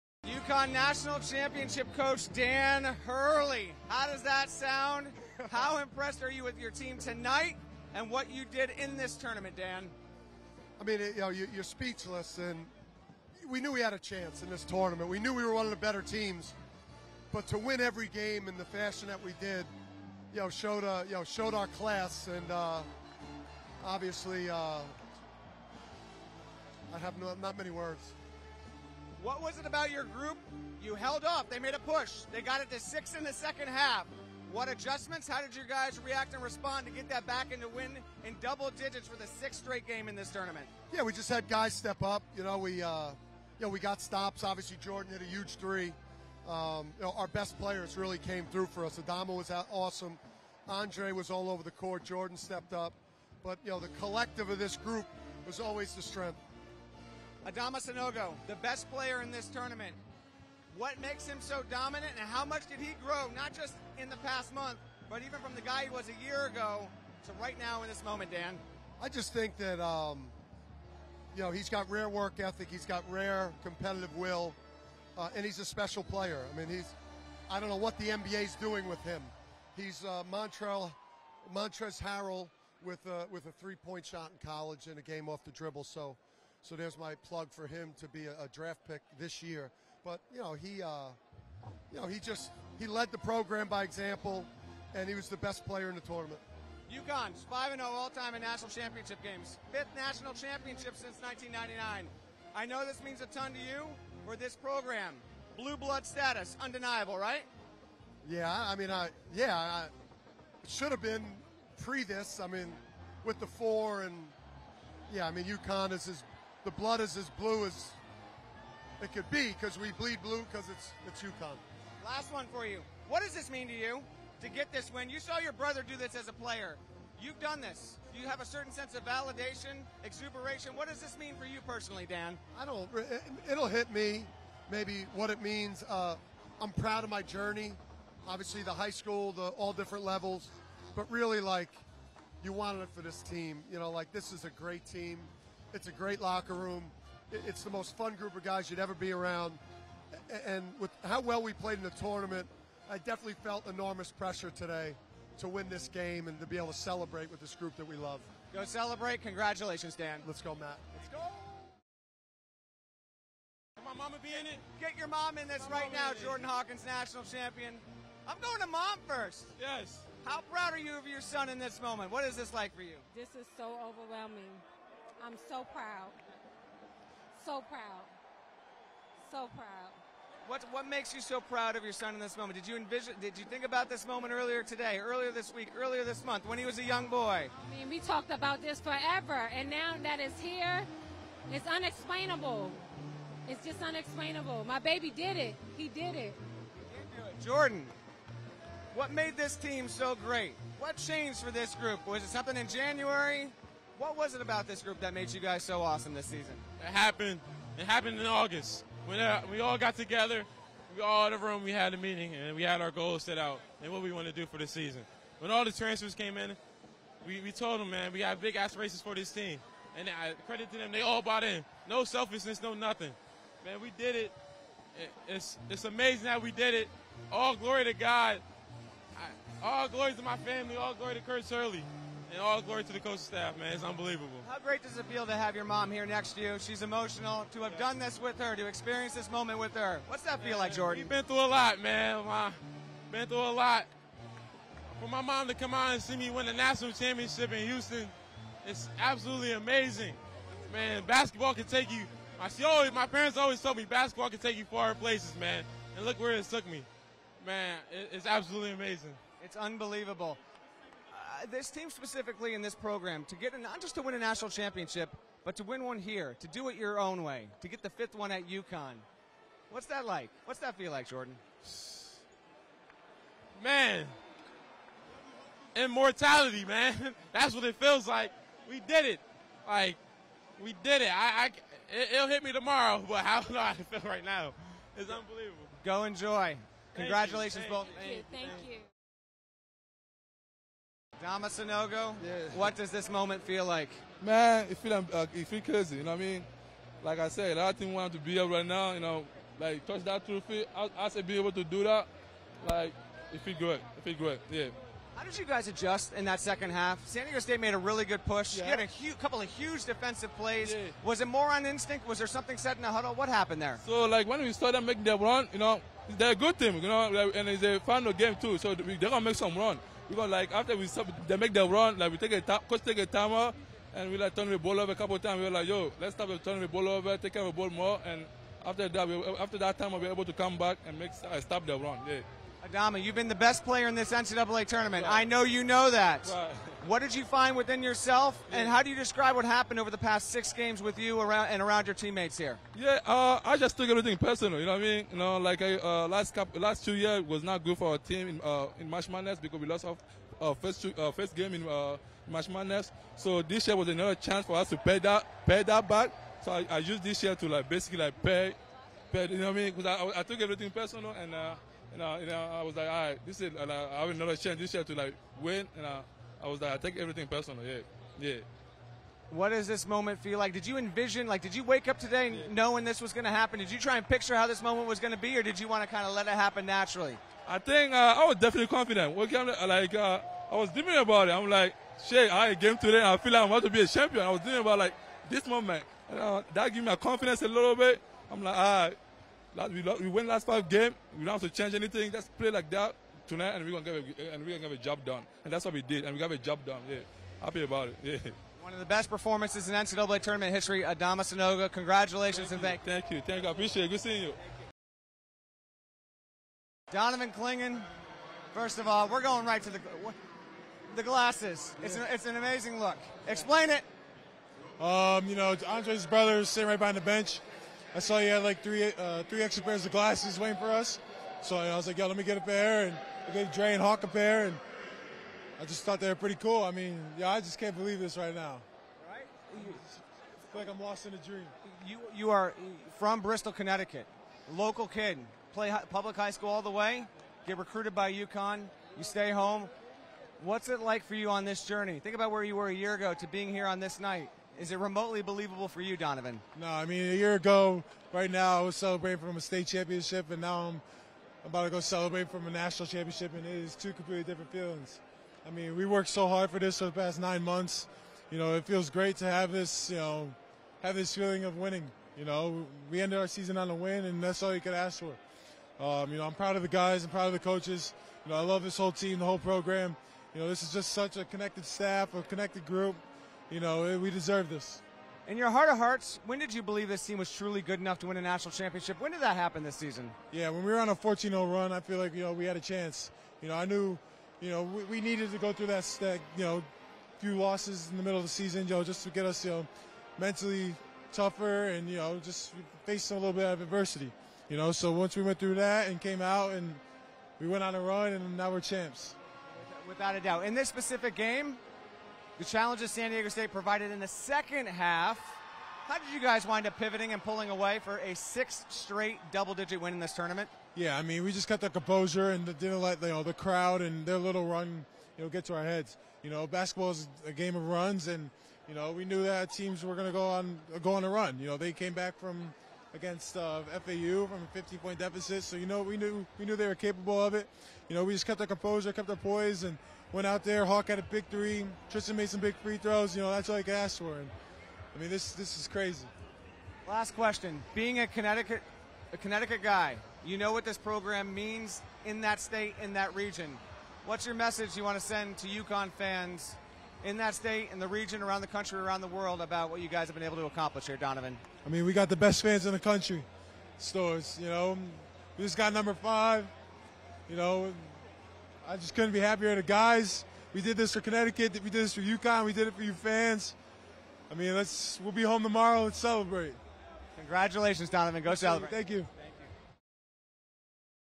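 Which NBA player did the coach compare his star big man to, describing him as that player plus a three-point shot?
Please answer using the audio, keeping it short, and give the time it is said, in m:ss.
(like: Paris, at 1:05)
Montrezl Harrell, at 1:21.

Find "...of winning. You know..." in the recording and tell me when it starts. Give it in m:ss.
7:41.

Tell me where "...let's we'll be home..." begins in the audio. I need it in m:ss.
9:24.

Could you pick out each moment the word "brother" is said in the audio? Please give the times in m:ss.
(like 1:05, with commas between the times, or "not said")
2:05, 6:56.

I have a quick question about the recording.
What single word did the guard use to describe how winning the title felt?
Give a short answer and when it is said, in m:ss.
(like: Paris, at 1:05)
Immortality, at 4:35.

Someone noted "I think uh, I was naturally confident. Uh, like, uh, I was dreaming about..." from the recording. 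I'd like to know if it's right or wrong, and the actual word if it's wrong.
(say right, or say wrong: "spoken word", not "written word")
wrong: "definitely", not "naturally".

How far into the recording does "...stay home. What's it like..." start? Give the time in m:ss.
7:19.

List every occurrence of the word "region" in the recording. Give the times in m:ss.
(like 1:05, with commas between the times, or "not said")
9:03, 9:07.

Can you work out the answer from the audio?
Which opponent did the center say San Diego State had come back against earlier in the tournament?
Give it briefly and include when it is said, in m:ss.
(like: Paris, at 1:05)
FAU, at 8:43.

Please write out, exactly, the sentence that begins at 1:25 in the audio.
So, so there's my plug for him to be a, a draft pick this year.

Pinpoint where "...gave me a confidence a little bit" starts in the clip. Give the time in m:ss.
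6:26.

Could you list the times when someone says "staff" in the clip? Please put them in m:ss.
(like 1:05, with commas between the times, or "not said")
3:53, 7:51.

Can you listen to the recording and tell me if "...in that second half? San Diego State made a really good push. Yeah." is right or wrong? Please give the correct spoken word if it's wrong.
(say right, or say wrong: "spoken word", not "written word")
right.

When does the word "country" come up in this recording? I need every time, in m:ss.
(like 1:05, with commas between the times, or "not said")
9:08, 9:12.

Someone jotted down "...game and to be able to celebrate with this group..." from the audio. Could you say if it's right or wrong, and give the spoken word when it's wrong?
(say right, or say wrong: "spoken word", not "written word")
right.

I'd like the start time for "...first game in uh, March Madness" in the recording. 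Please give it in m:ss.
5:51.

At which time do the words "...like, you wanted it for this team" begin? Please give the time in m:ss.
2:21.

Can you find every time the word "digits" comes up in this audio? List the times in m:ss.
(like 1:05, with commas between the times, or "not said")
0:38, 8:29.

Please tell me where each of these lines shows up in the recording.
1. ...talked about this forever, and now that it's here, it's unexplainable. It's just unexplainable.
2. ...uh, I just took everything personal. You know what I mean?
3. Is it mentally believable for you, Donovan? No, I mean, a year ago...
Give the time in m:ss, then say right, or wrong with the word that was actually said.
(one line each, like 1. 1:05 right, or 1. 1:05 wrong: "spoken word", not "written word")
1. 3:07 right
2. 5:43 right
3. 7:24 wrong: "remotely", not "mentally".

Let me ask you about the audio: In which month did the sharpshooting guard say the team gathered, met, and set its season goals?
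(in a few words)
August.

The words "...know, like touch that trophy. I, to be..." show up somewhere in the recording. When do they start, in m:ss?
4:58.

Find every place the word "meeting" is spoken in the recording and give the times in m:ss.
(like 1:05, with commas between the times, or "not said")
3:31.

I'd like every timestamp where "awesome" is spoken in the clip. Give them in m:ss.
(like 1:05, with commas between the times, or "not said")
0:49, 3:25.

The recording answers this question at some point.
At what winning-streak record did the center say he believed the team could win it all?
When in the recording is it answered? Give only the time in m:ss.
8:00.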